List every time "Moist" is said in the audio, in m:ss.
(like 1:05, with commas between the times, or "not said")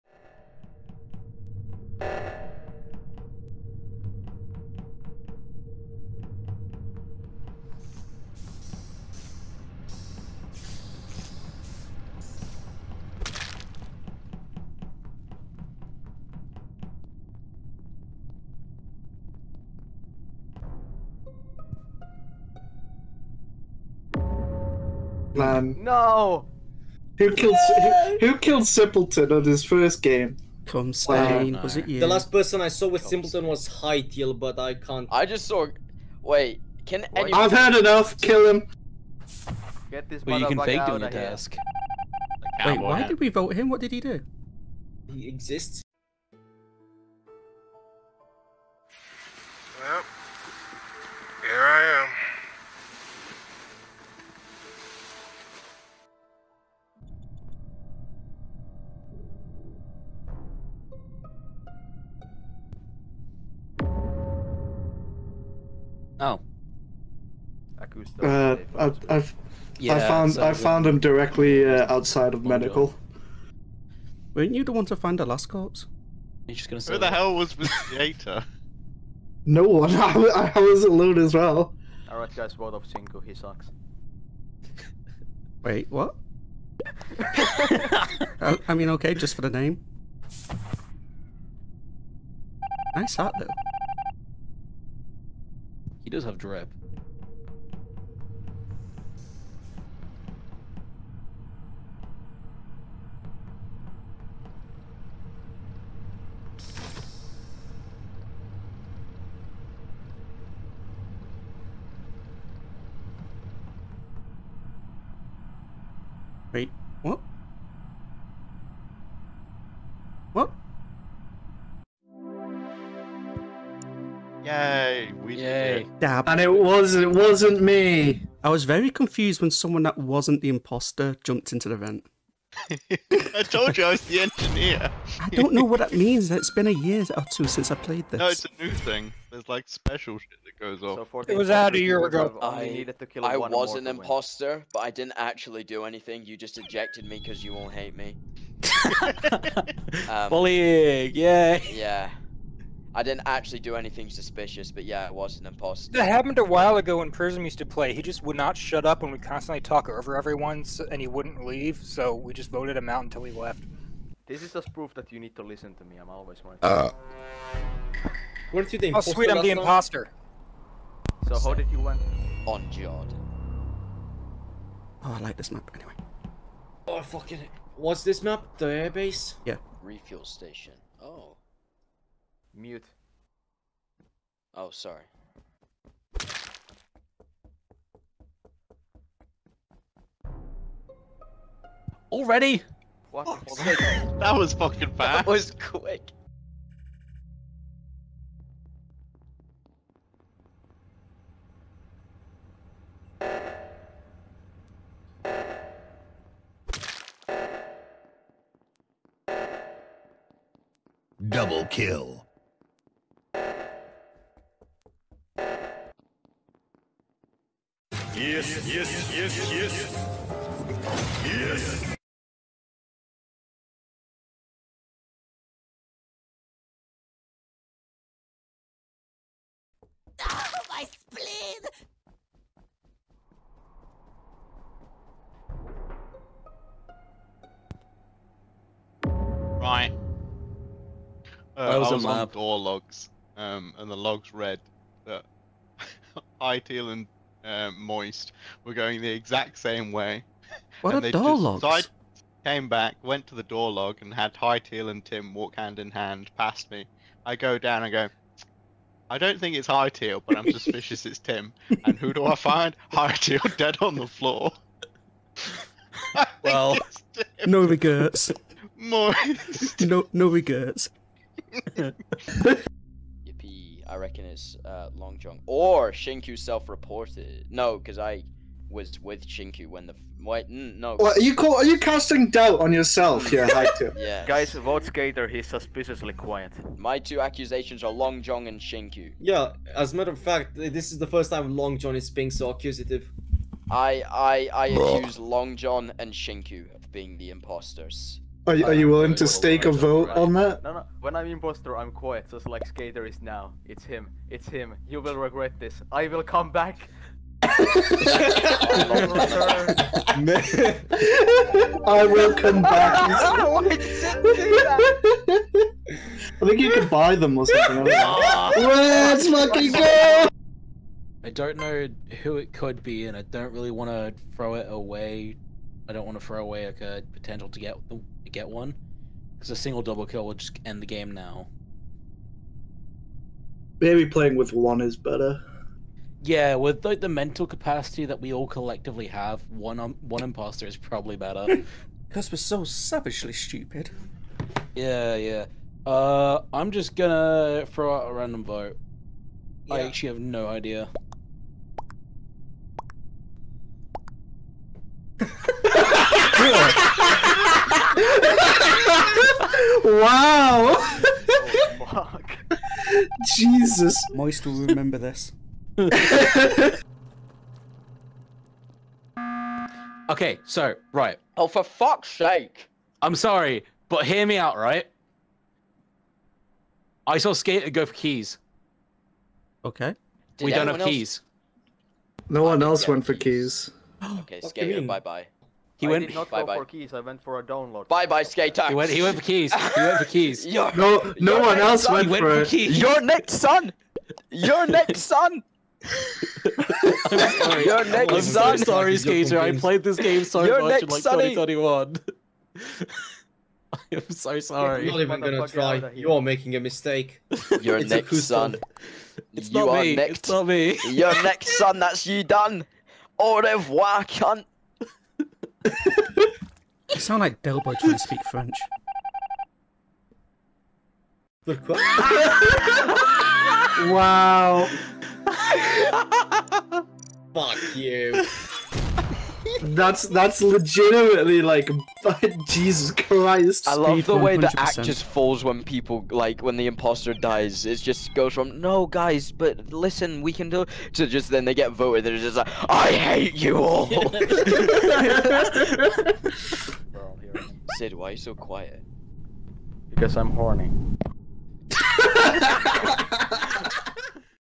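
4:07, 4:28, 6:04.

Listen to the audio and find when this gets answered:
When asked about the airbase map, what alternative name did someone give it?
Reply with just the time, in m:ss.
2:59.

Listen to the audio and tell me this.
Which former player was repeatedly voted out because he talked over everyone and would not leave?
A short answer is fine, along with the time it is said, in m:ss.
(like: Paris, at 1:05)
Prism, at 2:37.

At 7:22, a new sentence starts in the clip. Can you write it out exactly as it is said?
They're just like, I hate you all.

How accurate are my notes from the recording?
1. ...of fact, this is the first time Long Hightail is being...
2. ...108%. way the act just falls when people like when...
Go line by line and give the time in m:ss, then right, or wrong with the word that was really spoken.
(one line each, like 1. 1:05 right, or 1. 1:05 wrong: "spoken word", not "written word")
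1. 4:50 wrong: "John", not "Hightail"
2. 7:14 wrong: "100", not "108".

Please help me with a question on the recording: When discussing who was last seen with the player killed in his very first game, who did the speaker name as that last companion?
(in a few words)
Hytiel.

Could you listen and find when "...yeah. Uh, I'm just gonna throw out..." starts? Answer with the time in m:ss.
5:45.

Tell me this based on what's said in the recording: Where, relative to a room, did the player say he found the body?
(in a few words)
outside of medical.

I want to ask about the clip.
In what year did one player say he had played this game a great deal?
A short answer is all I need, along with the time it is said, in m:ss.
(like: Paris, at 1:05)
2021, at 6:41.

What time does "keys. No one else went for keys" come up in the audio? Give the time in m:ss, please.
6:20.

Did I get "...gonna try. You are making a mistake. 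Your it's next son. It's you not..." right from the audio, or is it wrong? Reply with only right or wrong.
right.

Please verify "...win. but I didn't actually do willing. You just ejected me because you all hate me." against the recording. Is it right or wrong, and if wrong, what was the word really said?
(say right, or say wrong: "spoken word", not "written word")
wrong: "anything", not "willing".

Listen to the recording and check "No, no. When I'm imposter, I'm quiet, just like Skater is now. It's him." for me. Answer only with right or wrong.
right.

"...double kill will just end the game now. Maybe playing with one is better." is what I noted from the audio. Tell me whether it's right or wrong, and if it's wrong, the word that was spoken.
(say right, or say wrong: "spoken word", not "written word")
right.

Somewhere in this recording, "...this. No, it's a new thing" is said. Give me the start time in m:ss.
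2:18.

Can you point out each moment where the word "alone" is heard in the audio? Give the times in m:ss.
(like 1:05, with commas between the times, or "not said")
1:20.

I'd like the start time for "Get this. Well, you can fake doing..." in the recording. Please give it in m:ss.
0:39.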